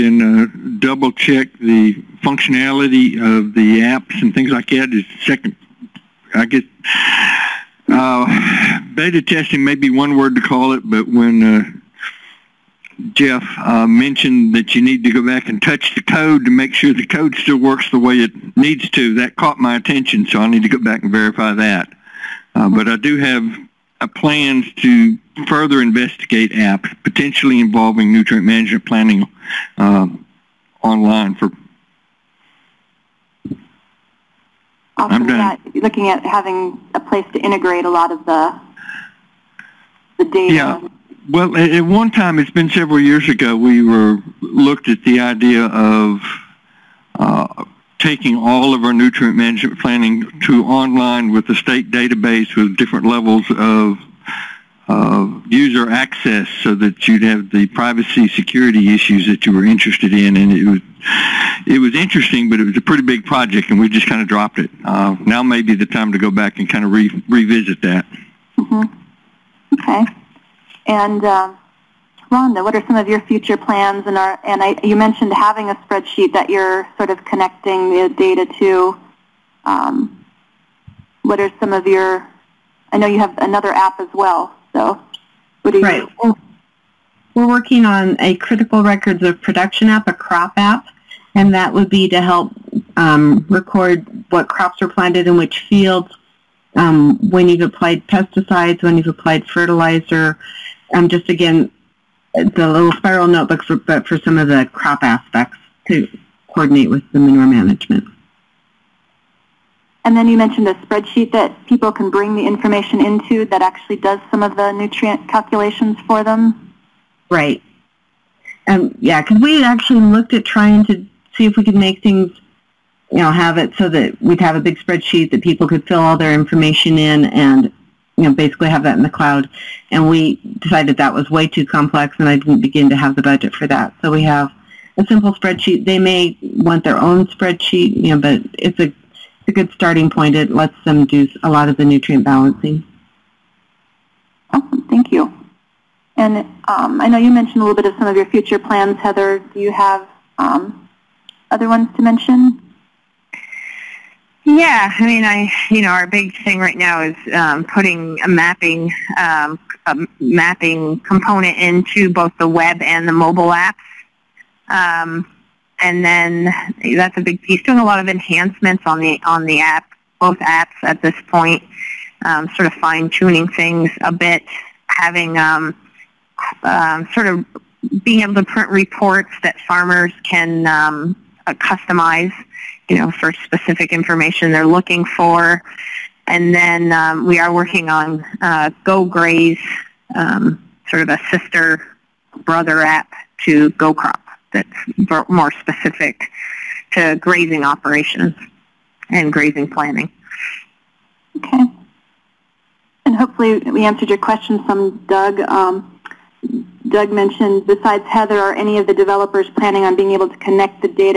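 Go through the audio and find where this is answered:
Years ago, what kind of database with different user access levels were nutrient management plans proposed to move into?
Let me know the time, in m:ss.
0:51.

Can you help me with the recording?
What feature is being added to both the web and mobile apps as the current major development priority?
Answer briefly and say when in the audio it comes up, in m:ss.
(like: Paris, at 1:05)
mapping component, at 2:40.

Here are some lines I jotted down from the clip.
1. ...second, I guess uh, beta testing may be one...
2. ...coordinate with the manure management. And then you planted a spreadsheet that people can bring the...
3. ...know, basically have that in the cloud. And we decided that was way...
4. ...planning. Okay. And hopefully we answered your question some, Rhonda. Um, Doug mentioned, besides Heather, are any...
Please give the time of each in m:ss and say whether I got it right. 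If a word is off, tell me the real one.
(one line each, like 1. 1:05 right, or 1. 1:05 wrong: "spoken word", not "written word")
1. 0:05 right
2. 1:46 wrong: "mentioned", not "planted"
3. 2:08 right
4. 3:19 wrong: "Doug", not "Rhonda".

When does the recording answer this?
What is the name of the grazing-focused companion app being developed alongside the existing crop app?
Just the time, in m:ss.
3:08.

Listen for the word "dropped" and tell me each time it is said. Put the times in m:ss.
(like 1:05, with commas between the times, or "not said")
1:04.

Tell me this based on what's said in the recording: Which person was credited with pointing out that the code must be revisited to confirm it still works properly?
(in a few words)
Jeff.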